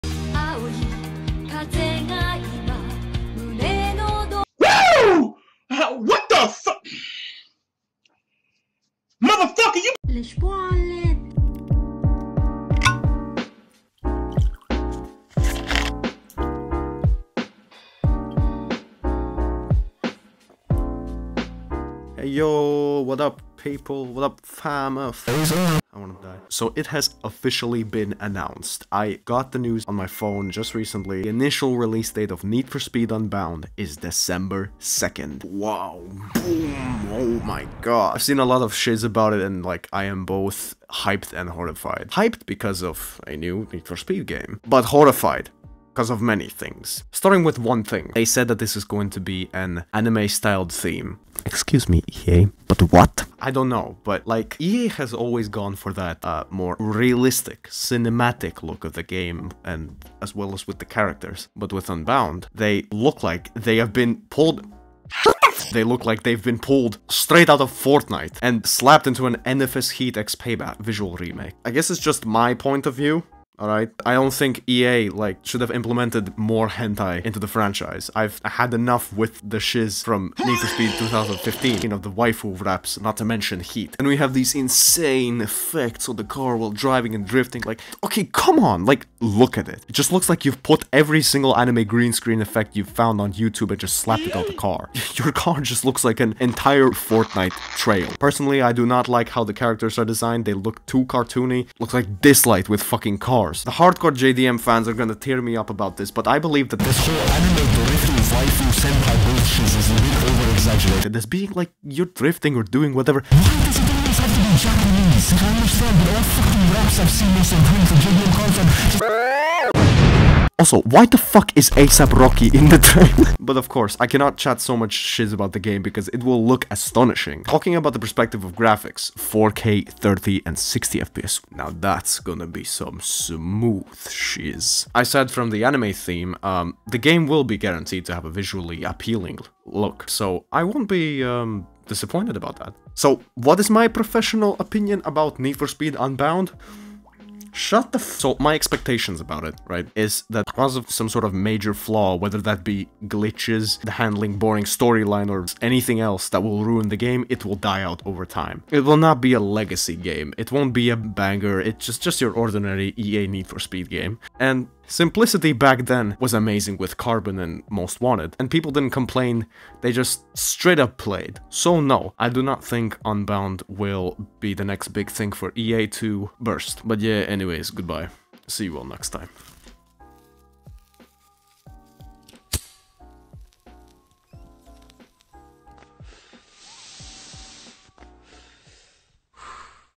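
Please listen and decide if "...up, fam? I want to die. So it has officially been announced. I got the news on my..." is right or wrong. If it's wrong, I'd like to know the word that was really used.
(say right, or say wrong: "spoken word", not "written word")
right.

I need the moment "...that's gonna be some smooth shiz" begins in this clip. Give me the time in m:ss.
2:11.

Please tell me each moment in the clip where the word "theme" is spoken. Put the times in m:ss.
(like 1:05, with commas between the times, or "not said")
0:50, 2:15.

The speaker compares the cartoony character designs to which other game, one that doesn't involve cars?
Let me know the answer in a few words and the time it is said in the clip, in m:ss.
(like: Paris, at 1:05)
Dislyte, at 1:42.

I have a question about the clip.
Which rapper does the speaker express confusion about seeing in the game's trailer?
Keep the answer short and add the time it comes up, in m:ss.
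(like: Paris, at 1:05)
ASAP Rocky, at 2:01.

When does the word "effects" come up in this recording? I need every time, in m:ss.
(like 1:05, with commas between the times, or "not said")
1:25, 1:32.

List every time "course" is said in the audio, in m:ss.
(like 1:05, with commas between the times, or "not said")
1:43, 2:03.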